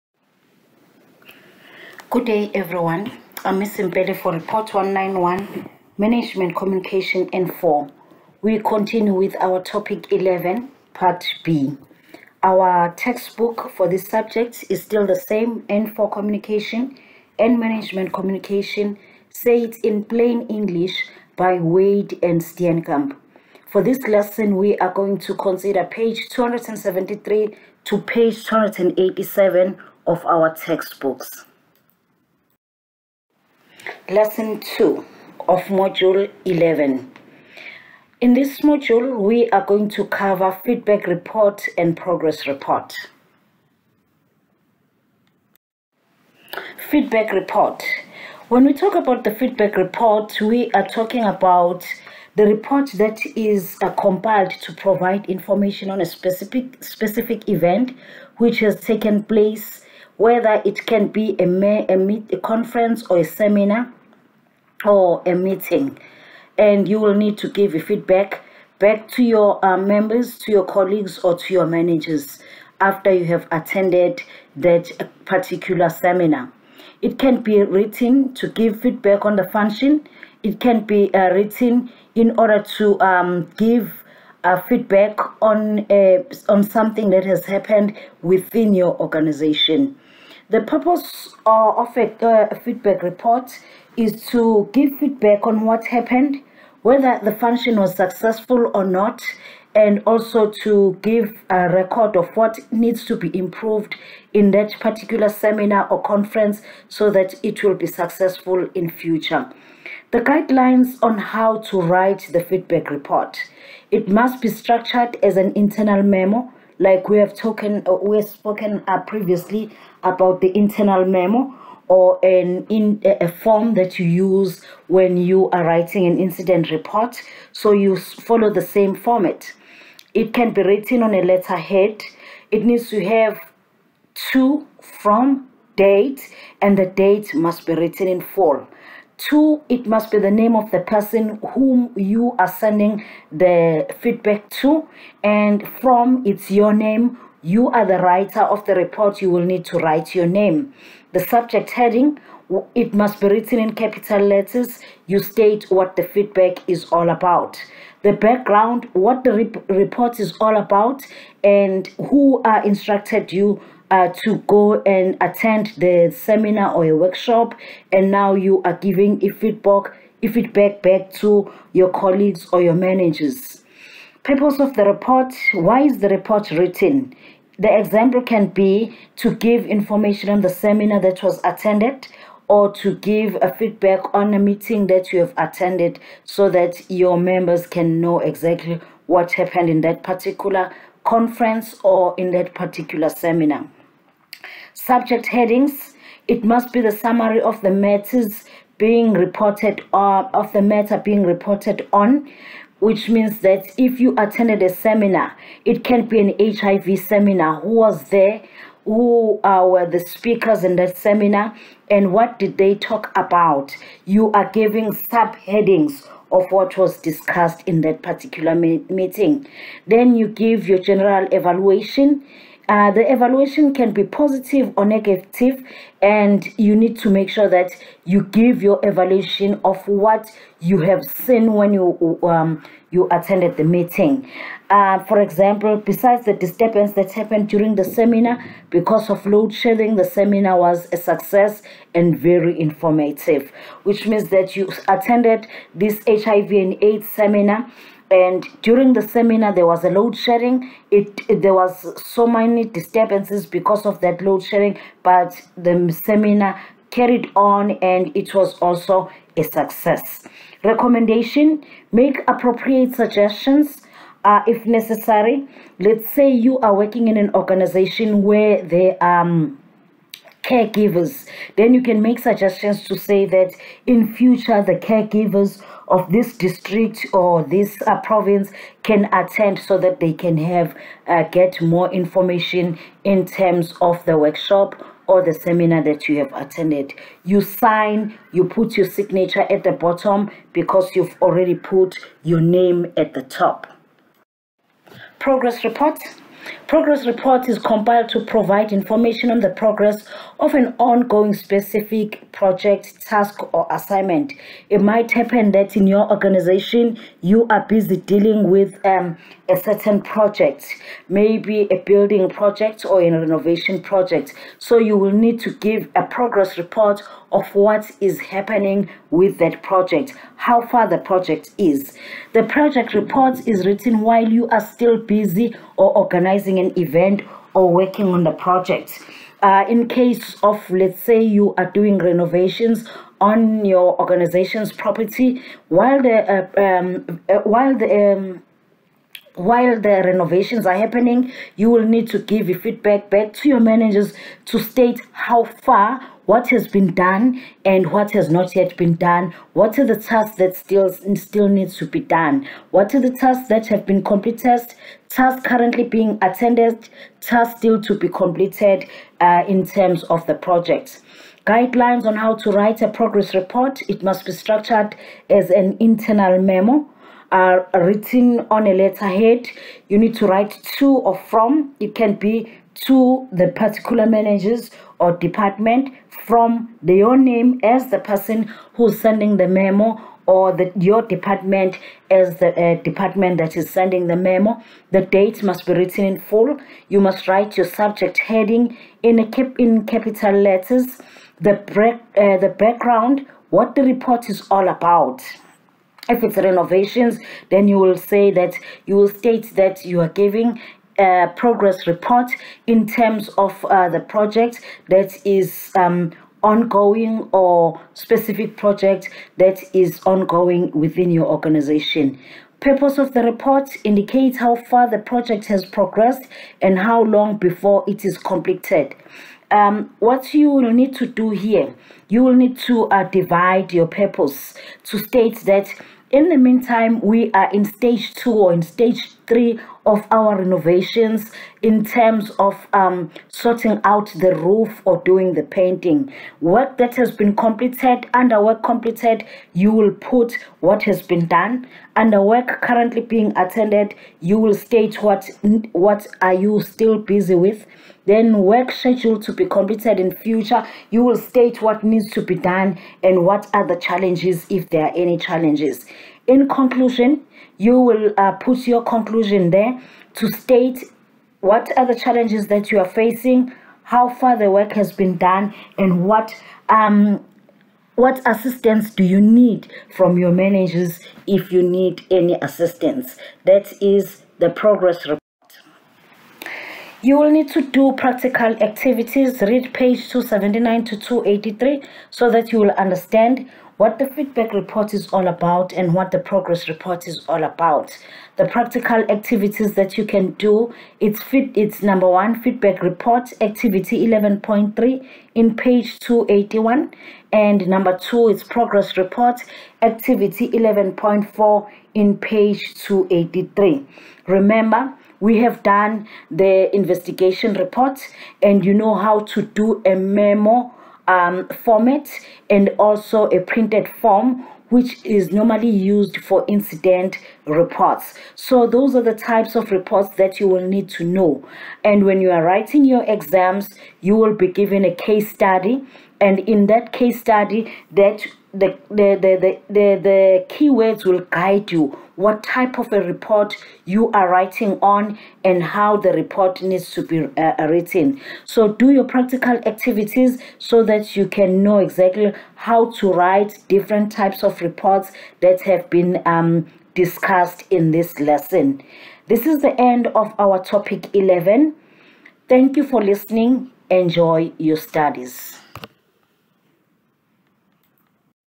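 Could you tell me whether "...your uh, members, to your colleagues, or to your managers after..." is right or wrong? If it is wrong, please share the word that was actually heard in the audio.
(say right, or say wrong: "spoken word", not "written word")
right.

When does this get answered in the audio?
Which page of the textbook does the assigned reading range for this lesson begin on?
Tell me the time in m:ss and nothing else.
0:25.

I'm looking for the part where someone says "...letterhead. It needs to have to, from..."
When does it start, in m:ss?
2:11.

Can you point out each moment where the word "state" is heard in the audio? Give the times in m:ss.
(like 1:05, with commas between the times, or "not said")
2:35, 5:44, 6:39, 7:04, 7:24, 7:31, 7:40.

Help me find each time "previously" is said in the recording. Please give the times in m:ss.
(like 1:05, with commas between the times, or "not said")
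1:59.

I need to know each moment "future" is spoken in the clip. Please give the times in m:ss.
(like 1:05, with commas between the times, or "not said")
1:48, 4:34, 7:30.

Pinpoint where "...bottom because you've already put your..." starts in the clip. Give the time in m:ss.
4:49.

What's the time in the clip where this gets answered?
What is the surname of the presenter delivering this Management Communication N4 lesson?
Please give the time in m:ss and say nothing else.
0:03.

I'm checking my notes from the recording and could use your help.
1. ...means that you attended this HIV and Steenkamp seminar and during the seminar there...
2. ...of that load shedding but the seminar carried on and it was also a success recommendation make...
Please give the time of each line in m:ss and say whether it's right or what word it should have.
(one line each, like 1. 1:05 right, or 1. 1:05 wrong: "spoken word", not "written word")
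1. 4:04 wrong: "AIDS", not "Steenkamp"
2. 4:13 right.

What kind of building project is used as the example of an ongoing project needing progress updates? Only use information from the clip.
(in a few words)
Renovation project.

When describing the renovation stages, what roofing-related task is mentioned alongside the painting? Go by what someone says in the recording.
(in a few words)
Sorting out the roof.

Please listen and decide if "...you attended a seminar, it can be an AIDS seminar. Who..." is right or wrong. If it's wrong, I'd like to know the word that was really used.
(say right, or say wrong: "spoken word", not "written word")
wrong: "HIV", not "AIDS".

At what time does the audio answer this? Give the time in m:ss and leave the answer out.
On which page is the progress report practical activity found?
8:22.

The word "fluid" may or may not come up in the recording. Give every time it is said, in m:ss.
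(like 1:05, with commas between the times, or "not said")
not said.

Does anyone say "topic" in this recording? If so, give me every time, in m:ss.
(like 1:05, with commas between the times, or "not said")
0:09, 9:10.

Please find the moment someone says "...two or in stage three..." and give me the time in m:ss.
7:08.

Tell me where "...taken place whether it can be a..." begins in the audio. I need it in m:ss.
0:58.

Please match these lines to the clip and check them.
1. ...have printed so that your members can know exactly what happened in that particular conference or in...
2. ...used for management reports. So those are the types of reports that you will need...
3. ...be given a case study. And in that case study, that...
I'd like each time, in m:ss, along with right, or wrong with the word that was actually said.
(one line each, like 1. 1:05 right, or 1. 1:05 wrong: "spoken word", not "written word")
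1. 3:05 wrong: "attended", not "printed"
2. 8:35 wrong: "incident", not "management"
3. 8:44 right.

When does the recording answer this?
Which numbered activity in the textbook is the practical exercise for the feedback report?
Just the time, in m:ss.
8:13.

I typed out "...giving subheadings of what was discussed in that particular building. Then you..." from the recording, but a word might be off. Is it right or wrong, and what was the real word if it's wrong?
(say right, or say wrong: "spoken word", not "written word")
wrong: "meeting", not "building".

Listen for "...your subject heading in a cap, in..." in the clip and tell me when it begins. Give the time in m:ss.
6:27.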